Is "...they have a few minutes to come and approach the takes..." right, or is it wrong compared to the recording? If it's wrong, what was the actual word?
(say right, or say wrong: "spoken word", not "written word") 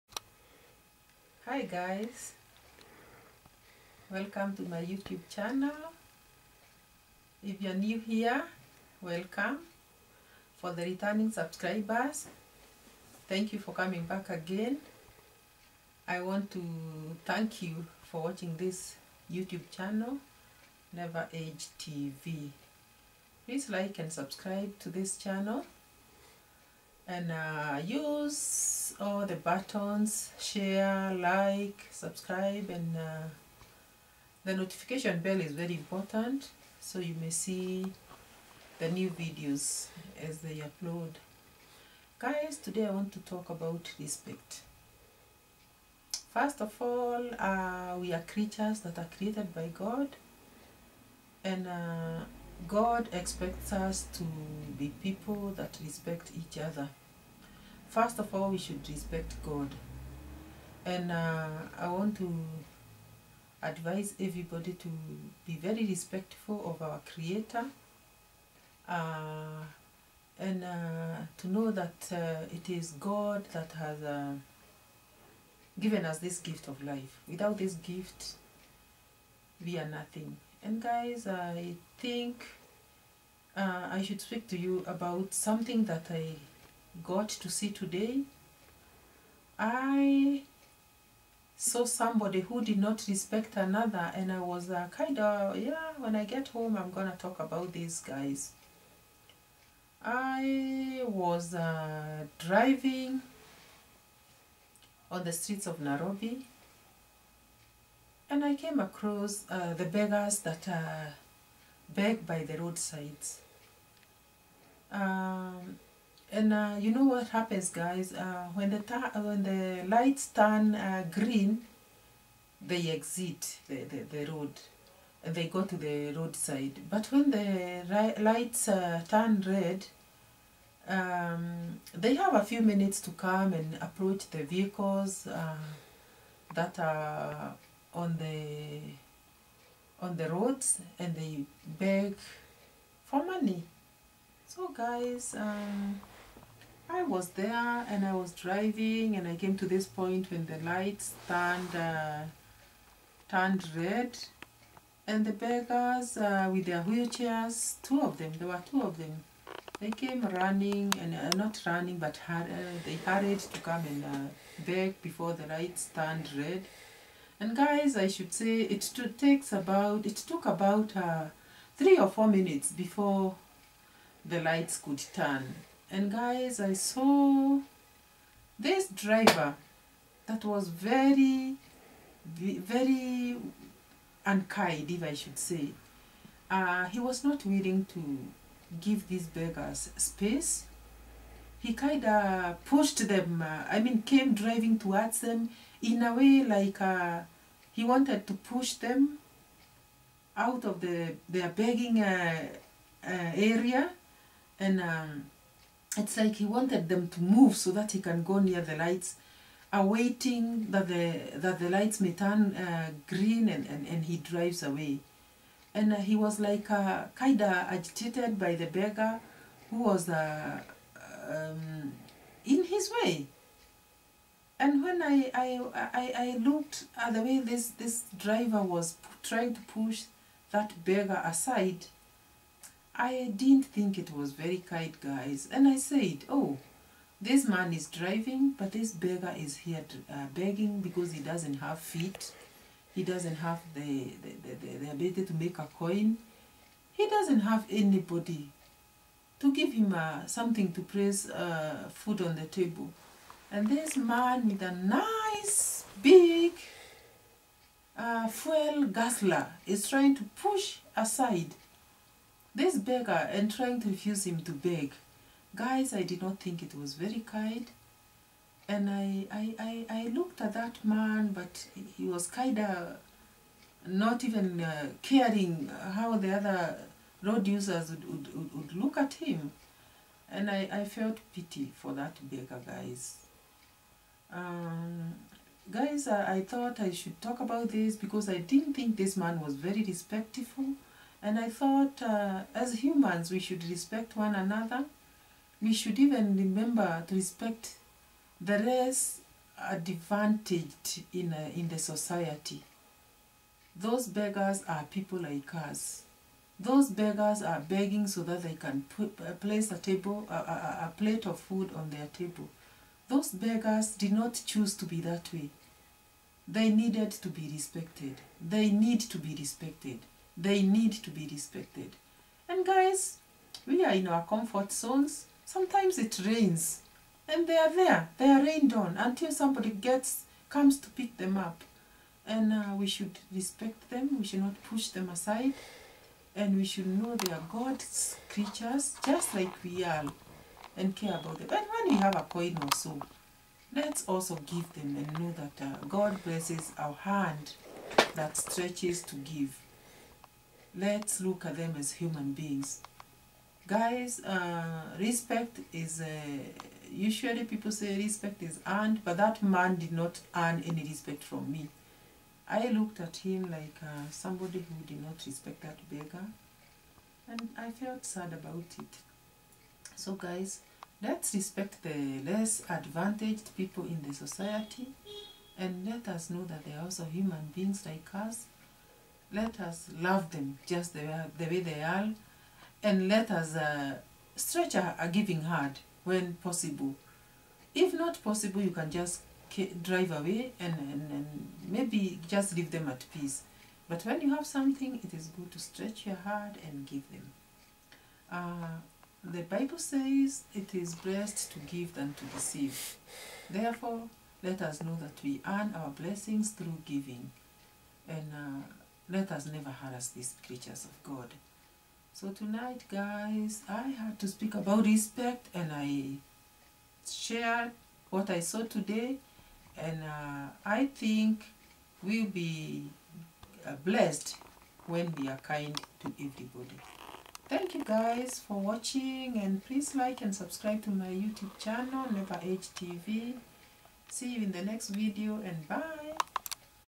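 wrong: "vehicles", not "takes".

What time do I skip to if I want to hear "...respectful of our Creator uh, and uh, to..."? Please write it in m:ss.
1:05.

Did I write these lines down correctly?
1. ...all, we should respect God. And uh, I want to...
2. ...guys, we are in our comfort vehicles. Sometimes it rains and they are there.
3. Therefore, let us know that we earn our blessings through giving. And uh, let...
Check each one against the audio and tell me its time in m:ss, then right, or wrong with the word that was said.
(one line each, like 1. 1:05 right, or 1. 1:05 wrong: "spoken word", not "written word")
1. 0:58 right
2. 5:22 wrong: "zones", not "vehicles"
3. 6:43 right.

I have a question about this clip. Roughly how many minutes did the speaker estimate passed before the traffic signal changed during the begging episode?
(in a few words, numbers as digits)
3 or 4.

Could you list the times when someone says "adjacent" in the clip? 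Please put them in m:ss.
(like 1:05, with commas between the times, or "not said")
not said.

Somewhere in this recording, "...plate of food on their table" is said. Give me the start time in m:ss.
5:10.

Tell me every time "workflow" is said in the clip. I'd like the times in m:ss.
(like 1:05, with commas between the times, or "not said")
not said.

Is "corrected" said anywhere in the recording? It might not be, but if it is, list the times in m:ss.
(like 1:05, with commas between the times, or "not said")
not said.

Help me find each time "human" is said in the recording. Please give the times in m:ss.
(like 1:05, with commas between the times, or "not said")
4:52, 5:51, 6:17.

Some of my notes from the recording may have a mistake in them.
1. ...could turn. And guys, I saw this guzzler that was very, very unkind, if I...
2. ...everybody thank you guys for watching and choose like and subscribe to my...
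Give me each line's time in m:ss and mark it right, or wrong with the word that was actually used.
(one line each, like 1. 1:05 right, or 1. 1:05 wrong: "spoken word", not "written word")
1. 2:54 wrong: "driver", not "guzzler"
2. 7:06 wrong: "please", not "choose".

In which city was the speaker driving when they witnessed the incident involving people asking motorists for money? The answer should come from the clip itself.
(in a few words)
Nairobi.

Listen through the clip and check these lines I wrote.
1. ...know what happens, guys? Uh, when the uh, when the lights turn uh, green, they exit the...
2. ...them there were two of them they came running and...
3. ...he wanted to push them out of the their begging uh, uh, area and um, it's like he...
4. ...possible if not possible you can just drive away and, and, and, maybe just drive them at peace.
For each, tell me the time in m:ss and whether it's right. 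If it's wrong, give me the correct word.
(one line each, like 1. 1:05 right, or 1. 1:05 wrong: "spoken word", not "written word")
1. 1:56 right
2. 2:38 right
3. 3:17 right
4. 6:26 wrong: "leave", not "drive".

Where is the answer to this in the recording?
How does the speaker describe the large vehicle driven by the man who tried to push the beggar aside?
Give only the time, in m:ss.
4:18.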